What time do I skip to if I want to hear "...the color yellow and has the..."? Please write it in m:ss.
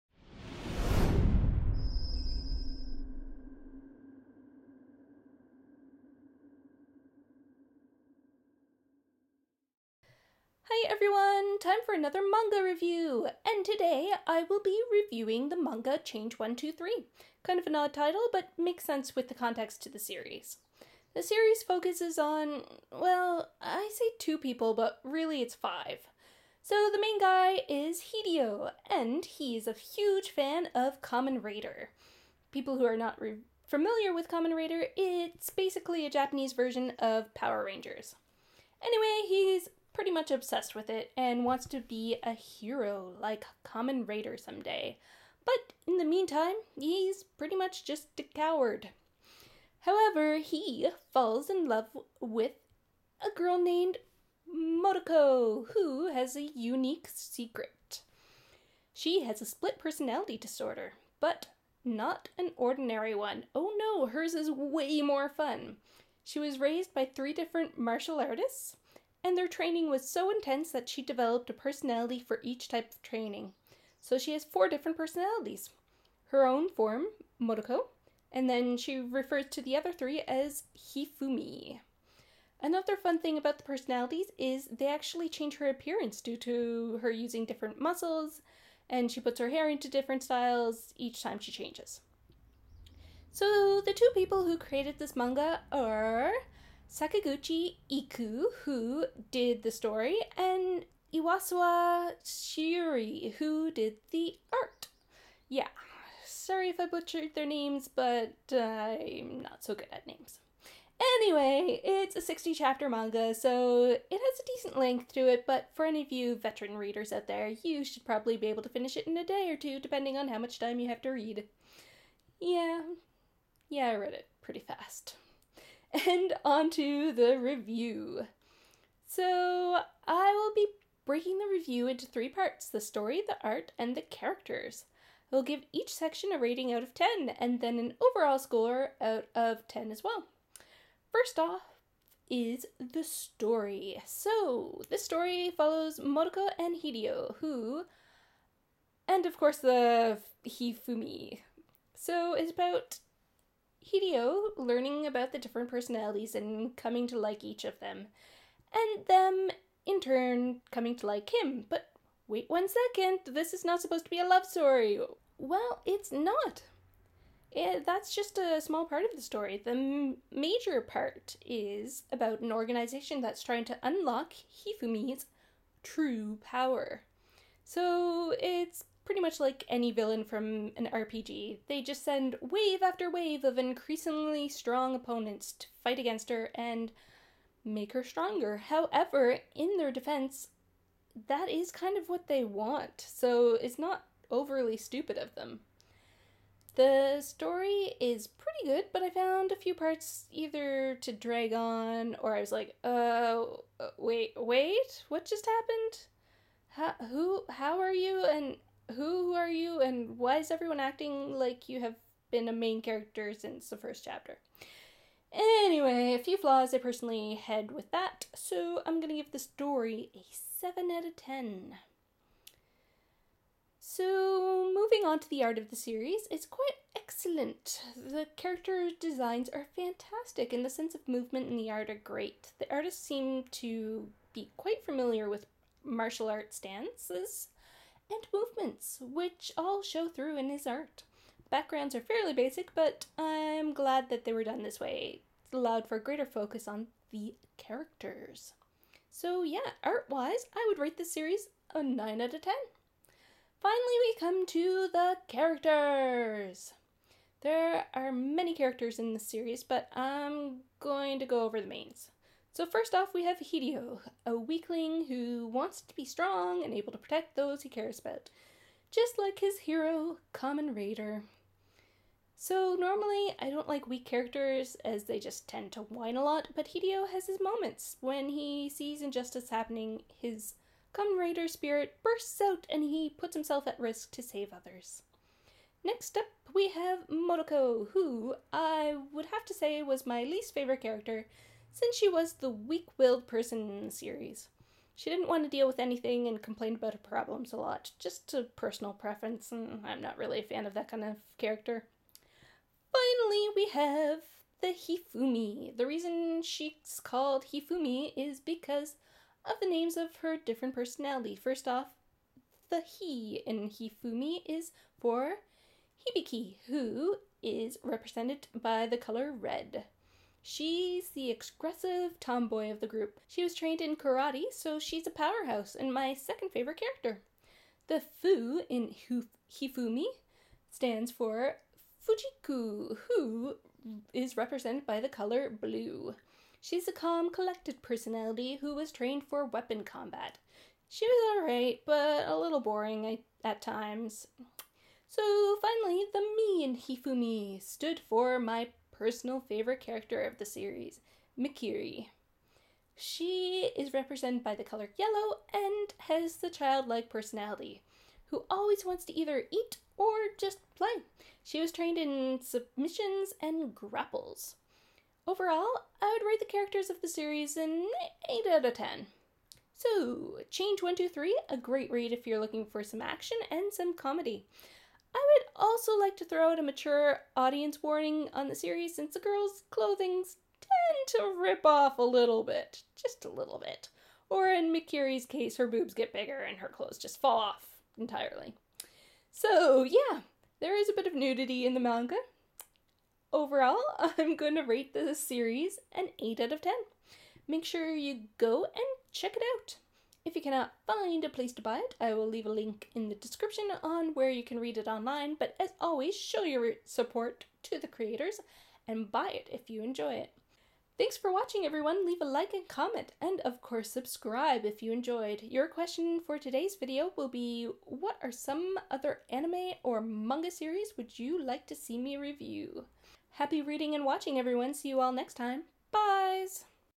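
5:54.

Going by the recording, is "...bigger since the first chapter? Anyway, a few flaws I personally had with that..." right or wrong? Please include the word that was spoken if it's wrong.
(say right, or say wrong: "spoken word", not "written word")
wrong: "character", not "bigger".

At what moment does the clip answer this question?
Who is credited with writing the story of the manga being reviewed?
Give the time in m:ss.
1:36.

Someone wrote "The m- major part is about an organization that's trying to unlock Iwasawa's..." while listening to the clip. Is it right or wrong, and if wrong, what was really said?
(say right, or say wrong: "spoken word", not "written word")
wrong: "Hifumi", not "Iwasawa".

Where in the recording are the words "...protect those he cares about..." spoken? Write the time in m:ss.
4:26.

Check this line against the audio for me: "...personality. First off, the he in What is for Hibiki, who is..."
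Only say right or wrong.
wrong.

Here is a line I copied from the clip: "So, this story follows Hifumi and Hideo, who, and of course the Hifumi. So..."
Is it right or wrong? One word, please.
wrong.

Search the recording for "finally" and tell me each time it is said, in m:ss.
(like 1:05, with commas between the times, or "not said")
4:13, 5:02, 5:45.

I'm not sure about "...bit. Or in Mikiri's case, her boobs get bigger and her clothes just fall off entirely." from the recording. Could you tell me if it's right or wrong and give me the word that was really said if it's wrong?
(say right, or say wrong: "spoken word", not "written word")
right.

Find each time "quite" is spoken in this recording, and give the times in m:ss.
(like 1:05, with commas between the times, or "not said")
3:46, 3:54.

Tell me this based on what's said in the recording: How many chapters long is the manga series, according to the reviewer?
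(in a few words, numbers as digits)
60.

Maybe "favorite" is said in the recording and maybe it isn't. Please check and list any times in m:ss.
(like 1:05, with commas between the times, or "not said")
4:50, 5:26, 5:49.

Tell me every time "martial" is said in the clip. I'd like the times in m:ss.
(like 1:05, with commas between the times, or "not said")
1:07, 3:55.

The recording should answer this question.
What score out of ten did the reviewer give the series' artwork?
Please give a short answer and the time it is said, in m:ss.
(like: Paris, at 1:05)
9, at 4:11.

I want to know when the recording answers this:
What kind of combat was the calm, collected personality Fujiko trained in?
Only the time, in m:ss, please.
5:39.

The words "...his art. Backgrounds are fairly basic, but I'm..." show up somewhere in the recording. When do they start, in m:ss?
4:00.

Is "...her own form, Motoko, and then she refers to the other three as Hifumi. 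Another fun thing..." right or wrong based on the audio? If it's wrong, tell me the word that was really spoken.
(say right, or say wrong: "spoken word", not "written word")
right.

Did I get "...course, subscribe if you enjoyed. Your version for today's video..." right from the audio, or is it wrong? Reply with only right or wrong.
wrong.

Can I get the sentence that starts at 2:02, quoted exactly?
Yeah, yeah, I read it pretty fast and onto the review.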